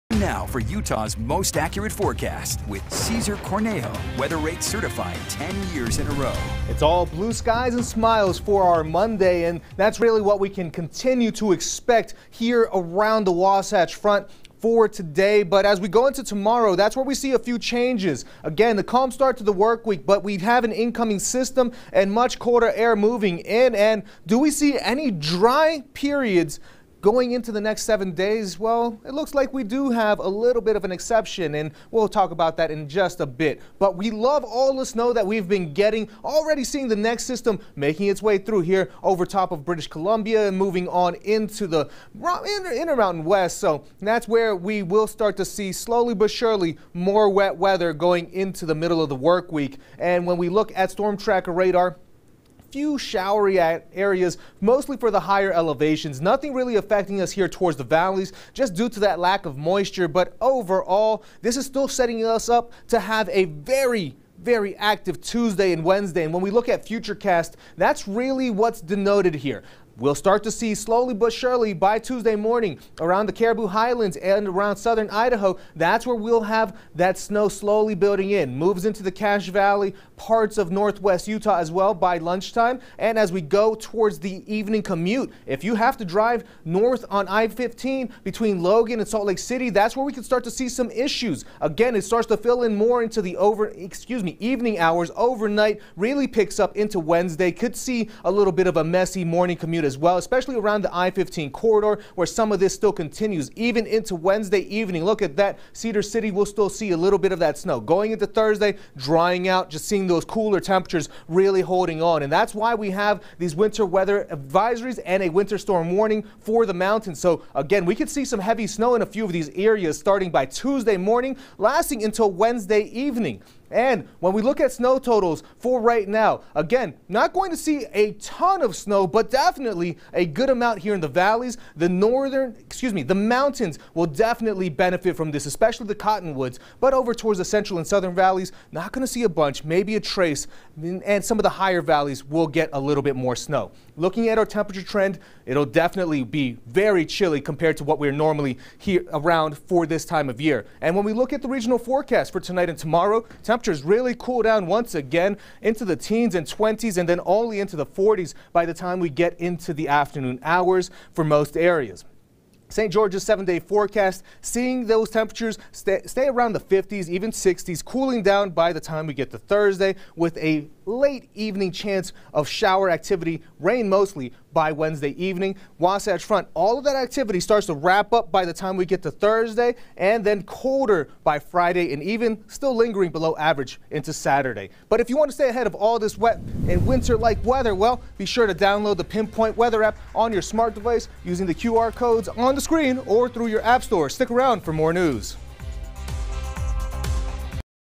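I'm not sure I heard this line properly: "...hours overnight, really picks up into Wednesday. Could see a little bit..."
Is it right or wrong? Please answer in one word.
right.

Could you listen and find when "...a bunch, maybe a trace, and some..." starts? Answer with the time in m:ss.
2:19.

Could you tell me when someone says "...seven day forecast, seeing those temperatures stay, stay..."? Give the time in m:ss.
2:43.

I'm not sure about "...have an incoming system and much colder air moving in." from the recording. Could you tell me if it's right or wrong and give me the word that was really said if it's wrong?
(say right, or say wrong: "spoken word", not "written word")
right.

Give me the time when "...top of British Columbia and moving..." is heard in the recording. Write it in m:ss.
0:39.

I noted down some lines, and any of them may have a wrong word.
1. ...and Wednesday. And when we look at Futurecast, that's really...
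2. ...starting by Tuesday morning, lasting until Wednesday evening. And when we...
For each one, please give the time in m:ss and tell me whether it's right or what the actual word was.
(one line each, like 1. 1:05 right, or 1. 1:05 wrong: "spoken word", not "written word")
1. 1:05 right
2. 1:59 right.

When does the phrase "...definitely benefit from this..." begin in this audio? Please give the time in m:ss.
2:14.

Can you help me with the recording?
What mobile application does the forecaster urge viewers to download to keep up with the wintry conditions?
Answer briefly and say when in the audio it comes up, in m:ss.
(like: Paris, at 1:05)
Pinpoint Weather app, at 3:09.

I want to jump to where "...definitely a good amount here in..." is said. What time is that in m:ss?
2:09.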